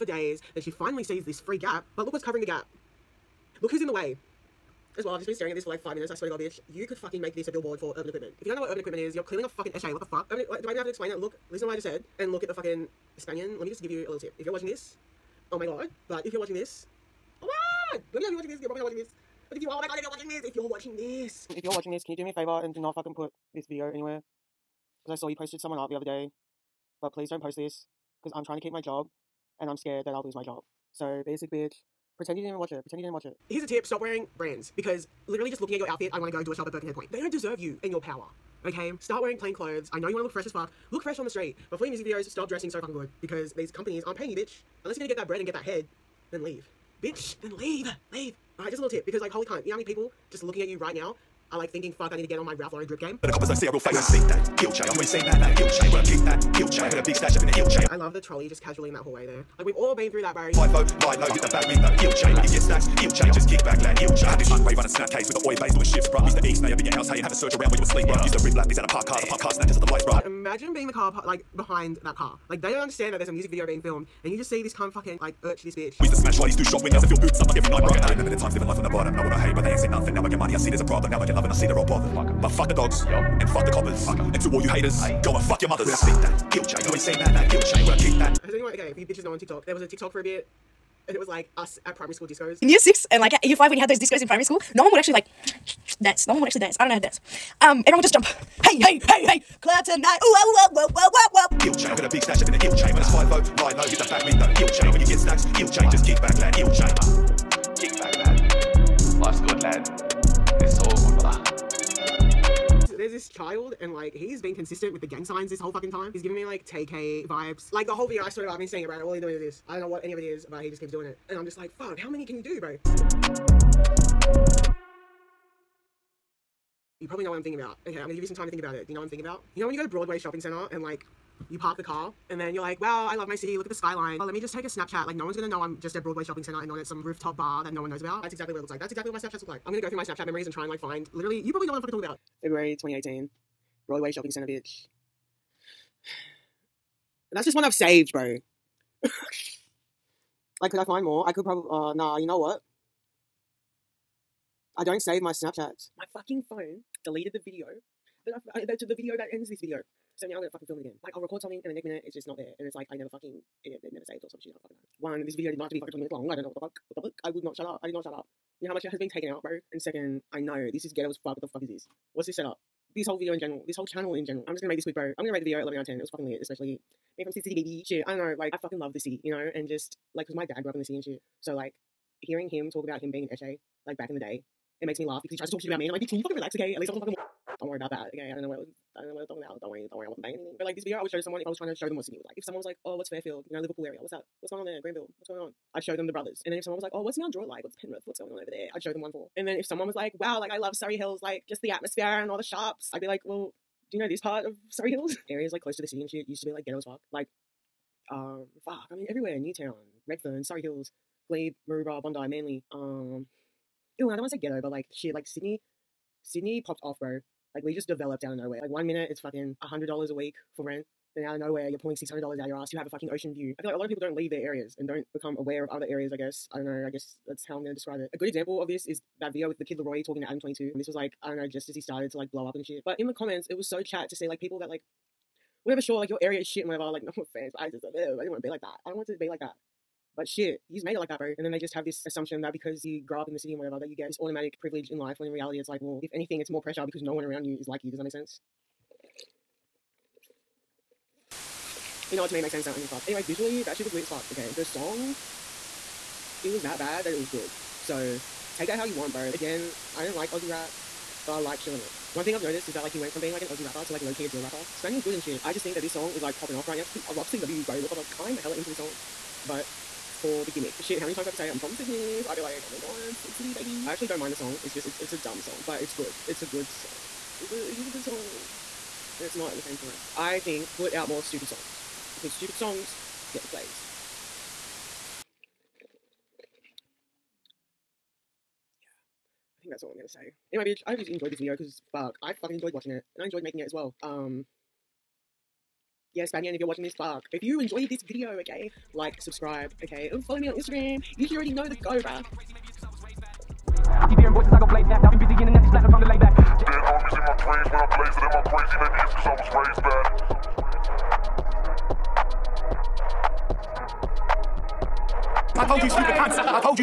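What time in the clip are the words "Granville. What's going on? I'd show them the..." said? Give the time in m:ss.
3:14.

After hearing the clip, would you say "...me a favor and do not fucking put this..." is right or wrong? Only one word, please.
right.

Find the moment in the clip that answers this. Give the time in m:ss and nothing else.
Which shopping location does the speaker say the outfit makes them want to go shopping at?
0:36.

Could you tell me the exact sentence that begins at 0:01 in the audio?
But look what's covering the gap.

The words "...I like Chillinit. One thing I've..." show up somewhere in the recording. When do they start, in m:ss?
4:21.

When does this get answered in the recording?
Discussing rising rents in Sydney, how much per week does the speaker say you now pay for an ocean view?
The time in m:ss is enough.
3:41.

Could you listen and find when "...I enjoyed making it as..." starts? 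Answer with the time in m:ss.
4:53.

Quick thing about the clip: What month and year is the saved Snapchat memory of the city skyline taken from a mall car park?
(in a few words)
February 2018.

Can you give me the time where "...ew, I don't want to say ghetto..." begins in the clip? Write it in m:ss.
3:33.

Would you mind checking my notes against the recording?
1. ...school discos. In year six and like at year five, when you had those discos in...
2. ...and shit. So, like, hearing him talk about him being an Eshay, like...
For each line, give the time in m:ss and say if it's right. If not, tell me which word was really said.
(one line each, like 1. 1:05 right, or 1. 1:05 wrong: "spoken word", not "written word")
1. 1:32 right
2. 3:00 right.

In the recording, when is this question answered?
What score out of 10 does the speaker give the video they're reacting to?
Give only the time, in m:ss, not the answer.
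2:55.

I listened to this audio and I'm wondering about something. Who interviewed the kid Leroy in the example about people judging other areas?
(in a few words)
Adam 22.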